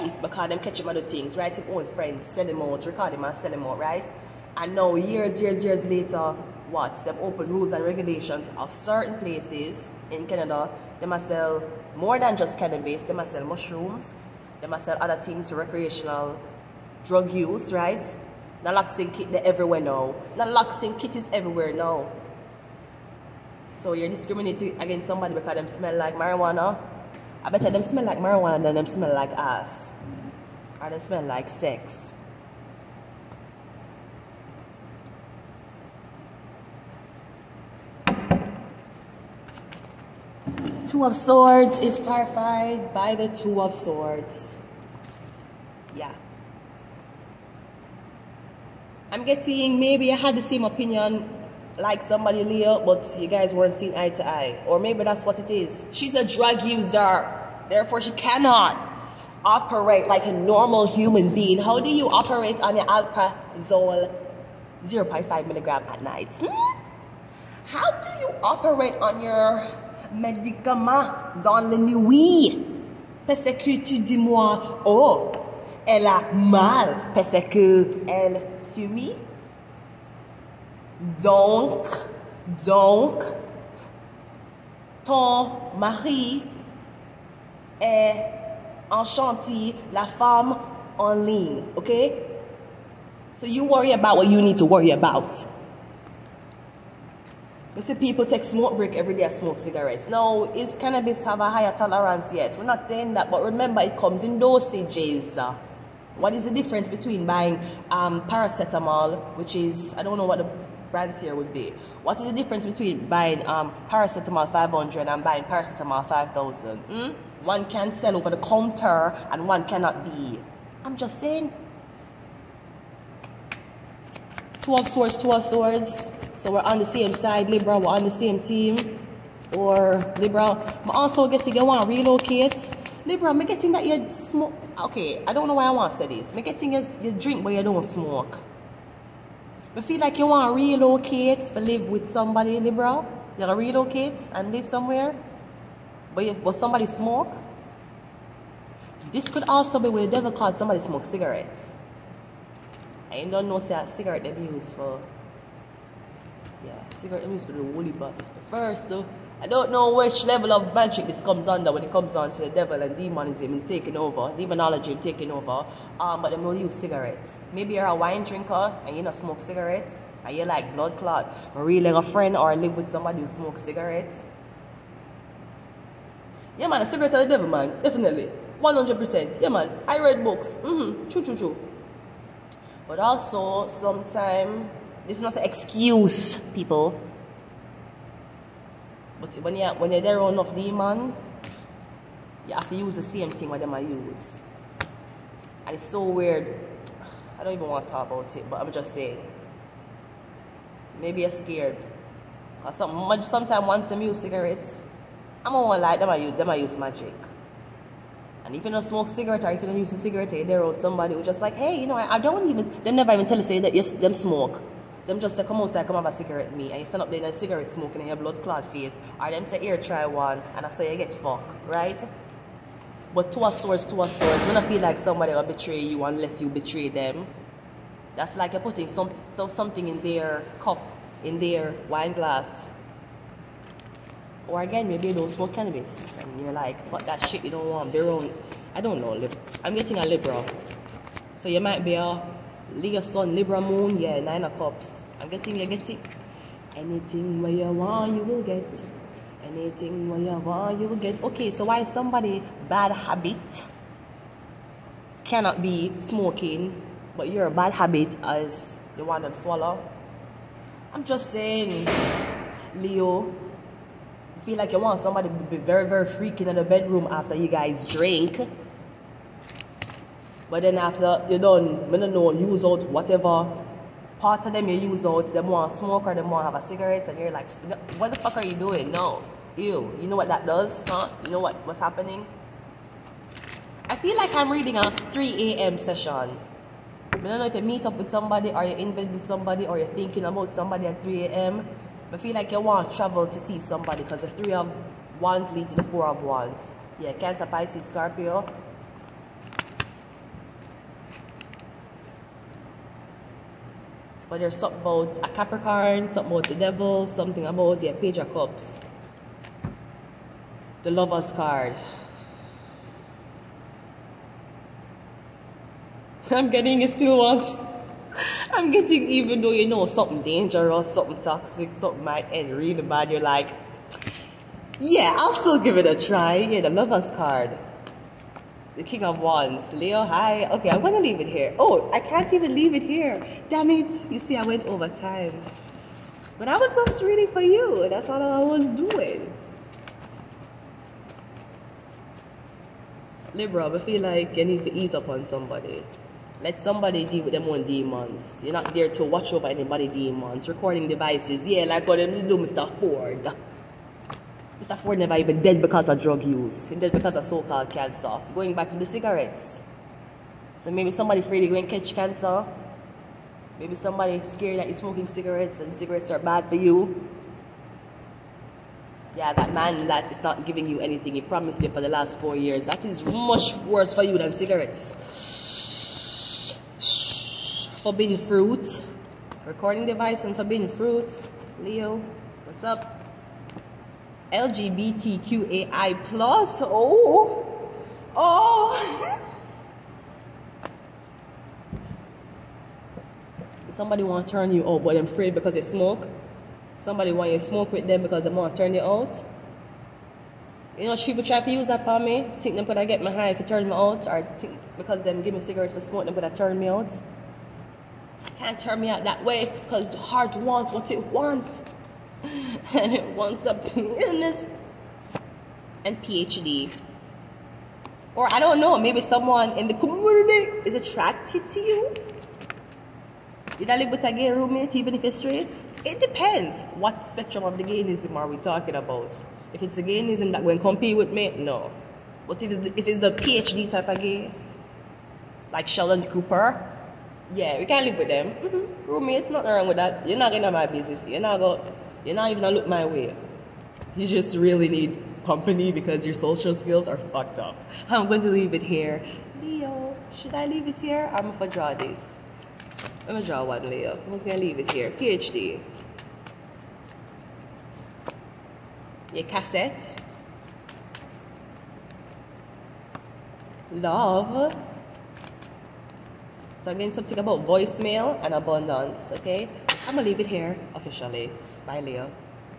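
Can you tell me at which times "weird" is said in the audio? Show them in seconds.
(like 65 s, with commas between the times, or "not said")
196 s.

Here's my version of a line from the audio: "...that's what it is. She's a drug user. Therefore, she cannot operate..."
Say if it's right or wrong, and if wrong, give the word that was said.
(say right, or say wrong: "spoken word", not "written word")
right.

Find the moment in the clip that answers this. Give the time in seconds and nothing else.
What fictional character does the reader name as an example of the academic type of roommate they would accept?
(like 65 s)
435 s.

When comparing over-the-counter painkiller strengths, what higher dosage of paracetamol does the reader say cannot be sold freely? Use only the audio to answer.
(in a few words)
5000.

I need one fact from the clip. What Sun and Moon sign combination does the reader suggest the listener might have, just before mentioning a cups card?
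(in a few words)
Leo Sun, Libra Moon.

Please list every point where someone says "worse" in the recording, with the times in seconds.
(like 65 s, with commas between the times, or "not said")
373 s.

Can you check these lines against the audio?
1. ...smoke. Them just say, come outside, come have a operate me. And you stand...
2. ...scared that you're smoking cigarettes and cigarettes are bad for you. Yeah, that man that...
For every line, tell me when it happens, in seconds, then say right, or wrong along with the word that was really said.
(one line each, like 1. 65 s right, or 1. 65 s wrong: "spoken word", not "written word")
1. 214 s wrong: "cigarette", not "operate"
2. 364 s right.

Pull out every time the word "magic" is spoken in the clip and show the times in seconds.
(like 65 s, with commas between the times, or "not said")
160 s, 206 s.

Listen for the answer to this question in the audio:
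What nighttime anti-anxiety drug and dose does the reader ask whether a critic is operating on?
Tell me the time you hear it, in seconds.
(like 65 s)
62 s.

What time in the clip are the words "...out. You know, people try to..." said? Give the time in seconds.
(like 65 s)
398 s.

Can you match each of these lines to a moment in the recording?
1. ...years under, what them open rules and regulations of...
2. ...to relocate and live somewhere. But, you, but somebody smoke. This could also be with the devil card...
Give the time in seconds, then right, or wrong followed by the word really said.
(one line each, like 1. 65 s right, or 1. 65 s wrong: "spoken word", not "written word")
1. 5 s wrong: "later", not "under"
2. 143 s right.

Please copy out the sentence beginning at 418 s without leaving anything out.
Or I don't know, maybe someone in the community is attracted to you.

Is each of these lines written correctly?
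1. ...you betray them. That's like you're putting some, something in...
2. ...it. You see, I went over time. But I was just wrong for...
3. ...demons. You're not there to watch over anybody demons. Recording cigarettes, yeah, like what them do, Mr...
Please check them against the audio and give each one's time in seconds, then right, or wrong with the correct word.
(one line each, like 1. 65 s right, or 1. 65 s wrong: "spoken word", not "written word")
1. 226 s right
2. 333 s wrong: "reading", not "wrong"
3. 347 s wrong: "devices", not "cigarettes".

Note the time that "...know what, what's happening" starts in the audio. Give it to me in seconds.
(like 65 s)
281 s.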